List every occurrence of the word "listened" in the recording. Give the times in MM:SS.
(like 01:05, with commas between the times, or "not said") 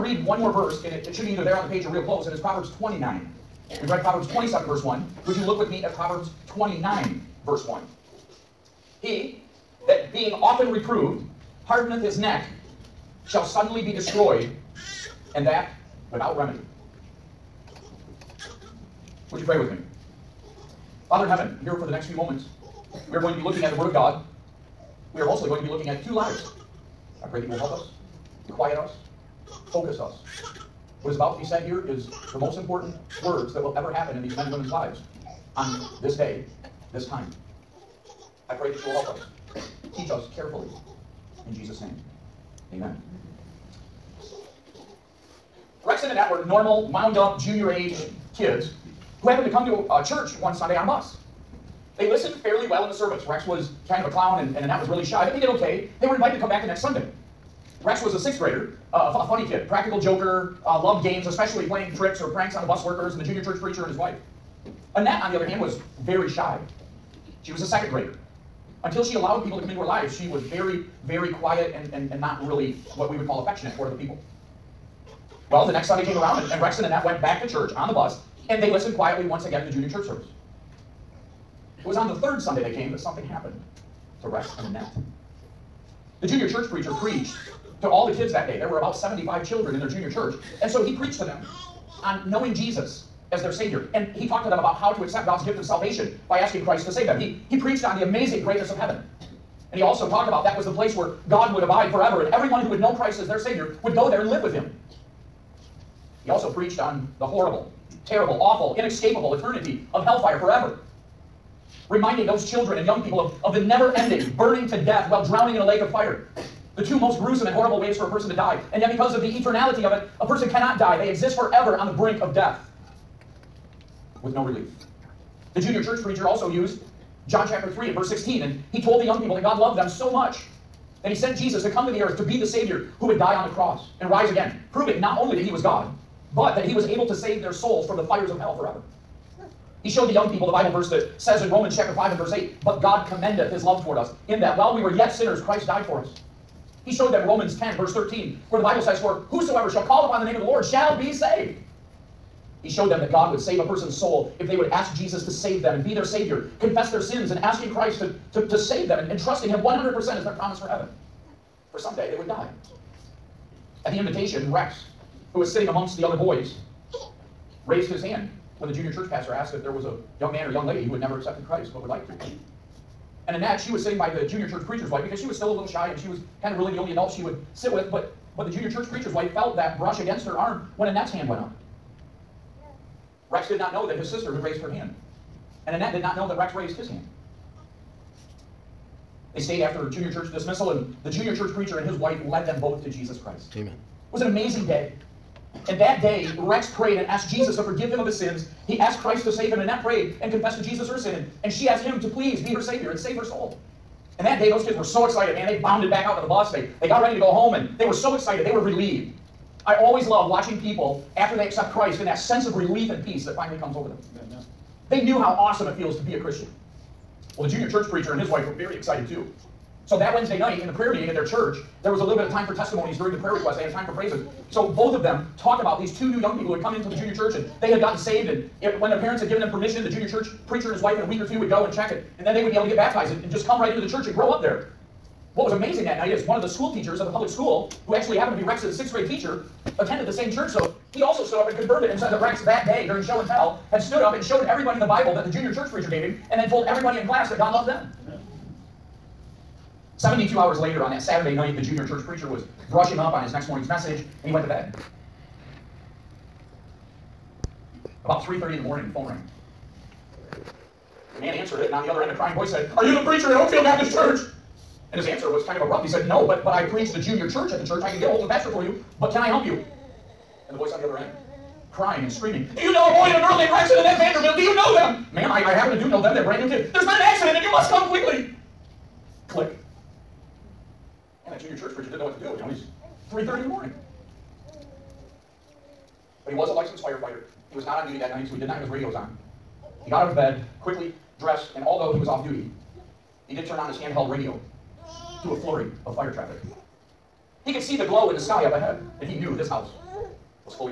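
00:52, 01:18.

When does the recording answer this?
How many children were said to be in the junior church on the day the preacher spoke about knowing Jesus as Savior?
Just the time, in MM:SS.
01:28.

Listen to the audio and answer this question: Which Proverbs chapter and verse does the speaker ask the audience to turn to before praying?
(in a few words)
Proverbs 29:1.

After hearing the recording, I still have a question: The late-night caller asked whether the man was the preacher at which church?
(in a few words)
Oakfield Baptist Church.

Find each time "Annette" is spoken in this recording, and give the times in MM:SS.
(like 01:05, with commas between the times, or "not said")
00:46, 01:04, 01:16, 01:24, 02:53, 03:00, 03:05, 03:19.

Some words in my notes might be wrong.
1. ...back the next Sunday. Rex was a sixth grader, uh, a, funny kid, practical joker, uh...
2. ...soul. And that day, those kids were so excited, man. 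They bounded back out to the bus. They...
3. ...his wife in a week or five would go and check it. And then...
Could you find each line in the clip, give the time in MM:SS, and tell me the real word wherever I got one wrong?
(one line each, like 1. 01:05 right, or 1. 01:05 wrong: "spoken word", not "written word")
1. 00:56 right
2. 03:23 right
3. 03:50 wrong: "two", not "five".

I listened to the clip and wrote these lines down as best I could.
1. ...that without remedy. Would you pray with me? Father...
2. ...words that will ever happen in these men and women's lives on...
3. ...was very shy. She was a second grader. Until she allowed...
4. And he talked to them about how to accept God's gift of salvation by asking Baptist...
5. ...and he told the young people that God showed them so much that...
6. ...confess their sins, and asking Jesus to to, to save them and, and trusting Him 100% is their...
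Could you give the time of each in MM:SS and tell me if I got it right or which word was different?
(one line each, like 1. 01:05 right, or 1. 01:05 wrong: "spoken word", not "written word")
1. 00:15 right
2. 00:33 right
3. 01:05 right
4. 01:33 wrong: "Christ", not "Baptist"
5. 02:08 wrong: "loved", not "showed"
6. 02:36 wrong: "Christ", not "Jesus".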